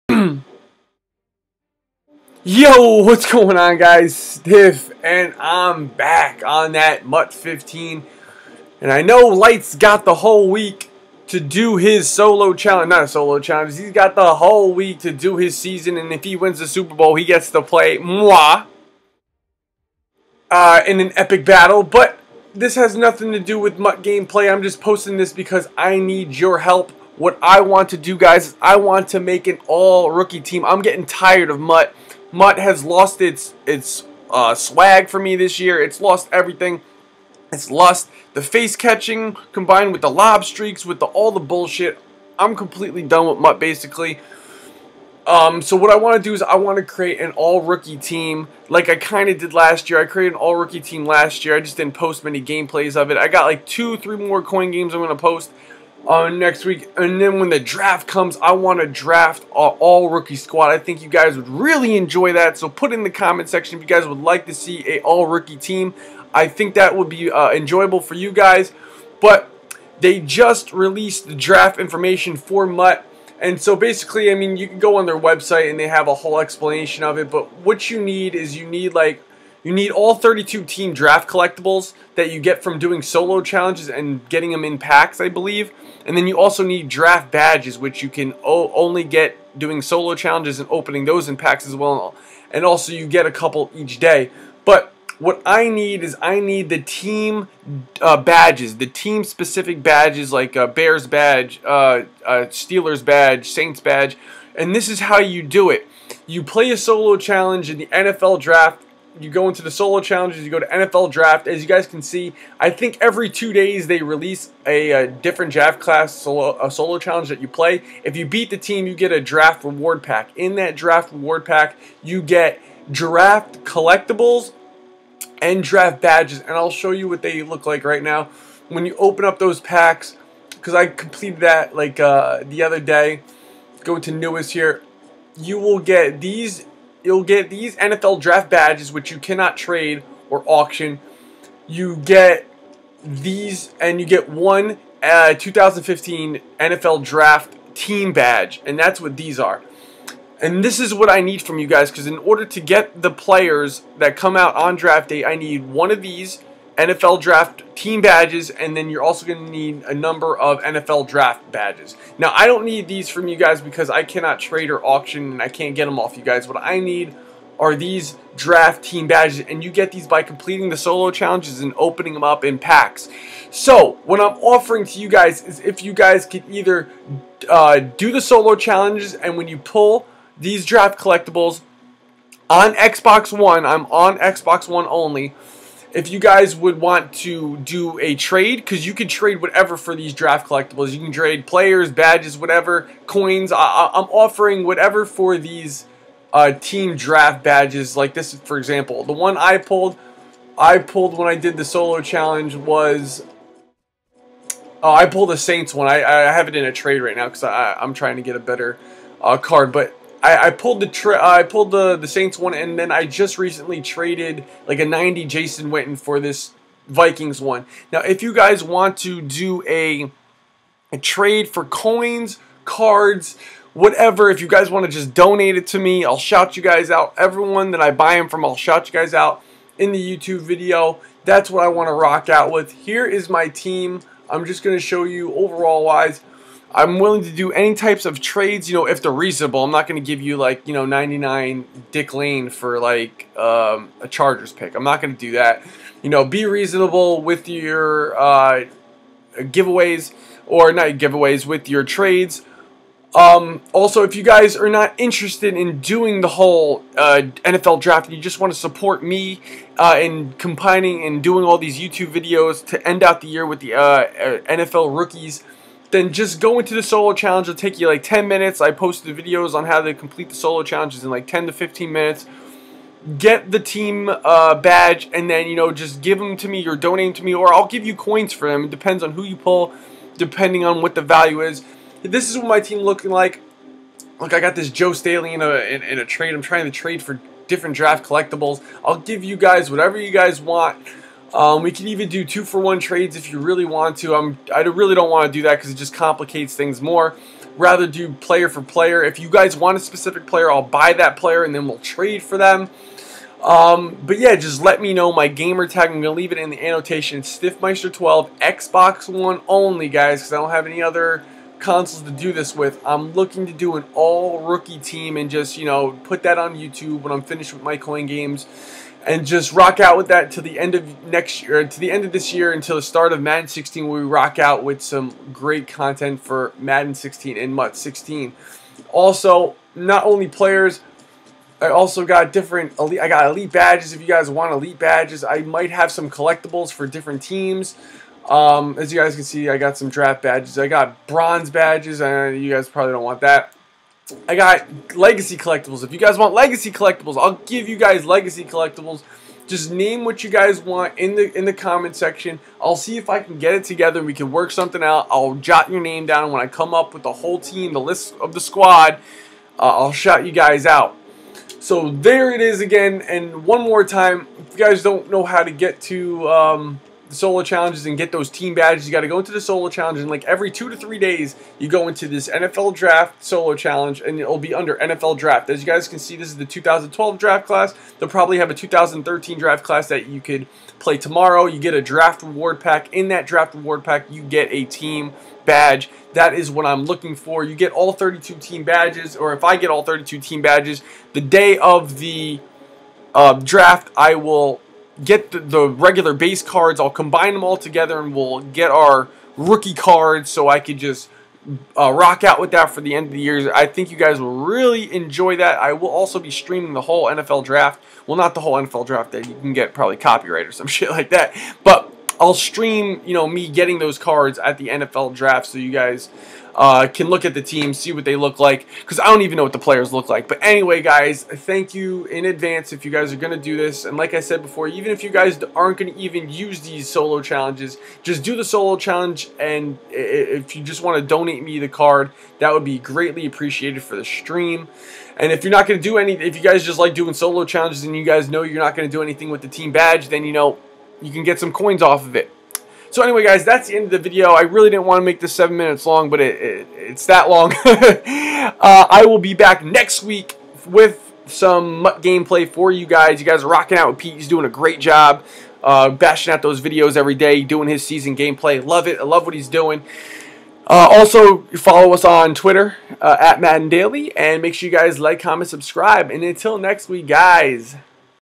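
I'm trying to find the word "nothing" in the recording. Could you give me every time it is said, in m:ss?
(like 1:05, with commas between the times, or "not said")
0:22.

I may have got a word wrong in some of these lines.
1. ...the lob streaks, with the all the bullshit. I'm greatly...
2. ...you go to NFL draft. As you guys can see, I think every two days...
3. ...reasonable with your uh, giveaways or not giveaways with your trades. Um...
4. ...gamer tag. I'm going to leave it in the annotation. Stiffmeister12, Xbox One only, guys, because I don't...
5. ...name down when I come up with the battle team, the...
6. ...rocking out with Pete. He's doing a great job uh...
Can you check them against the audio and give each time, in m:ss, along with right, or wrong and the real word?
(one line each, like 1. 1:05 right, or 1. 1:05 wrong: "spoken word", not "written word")
1. 0:40 wrong: "completely", not "greatly"
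2. 1:50 right
3. 4:06 right
4. 5:05 right
5. 5:55 wrong: "whole", not "battle"
6. 7:33 right.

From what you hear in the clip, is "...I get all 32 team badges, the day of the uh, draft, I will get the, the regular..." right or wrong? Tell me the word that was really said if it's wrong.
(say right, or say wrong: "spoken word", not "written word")
right.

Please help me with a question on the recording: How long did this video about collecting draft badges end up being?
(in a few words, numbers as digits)
7 minutes.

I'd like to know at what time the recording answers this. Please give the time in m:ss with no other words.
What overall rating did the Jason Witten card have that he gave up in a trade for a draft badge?
3:34.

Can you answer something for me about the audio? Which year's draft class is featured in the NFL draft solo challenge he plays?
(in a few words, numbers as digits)
2012.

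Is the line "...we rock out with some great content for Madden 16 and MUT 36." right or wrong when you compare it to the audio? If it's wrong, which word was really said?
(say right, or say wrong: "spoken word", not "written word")
wrong: "16", not "36".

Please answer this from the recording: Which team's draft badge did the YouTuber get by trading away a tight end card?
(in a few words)
Vikings.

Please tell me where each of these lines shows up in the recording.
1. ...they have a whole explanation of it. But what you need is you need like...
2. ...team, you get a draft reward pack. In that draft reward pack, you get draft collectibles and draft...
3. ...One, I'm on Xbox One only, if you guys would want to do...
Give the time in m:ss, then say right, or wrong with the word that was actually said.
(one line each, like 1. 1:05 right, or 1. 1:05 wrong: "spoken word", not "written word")
1. 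1:15 right
2. 1:58 right
3. 3:03 right.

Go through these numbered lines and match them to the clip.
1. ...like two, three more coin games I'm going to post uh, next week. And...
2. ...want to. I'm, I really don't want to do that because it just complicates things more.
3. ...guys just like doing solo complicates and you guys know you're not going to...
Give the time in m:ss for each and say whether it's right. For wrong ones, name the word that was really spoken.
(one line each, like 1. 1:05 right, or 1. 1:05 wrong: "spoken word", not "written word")
1. 0:53 right
2. 4:53 right
3. 7:16 wrong: "challenges", not "complicates".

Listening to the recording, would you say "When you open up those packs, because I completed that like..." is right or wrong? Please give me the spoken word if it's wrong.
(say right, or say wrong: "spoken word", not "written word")
right.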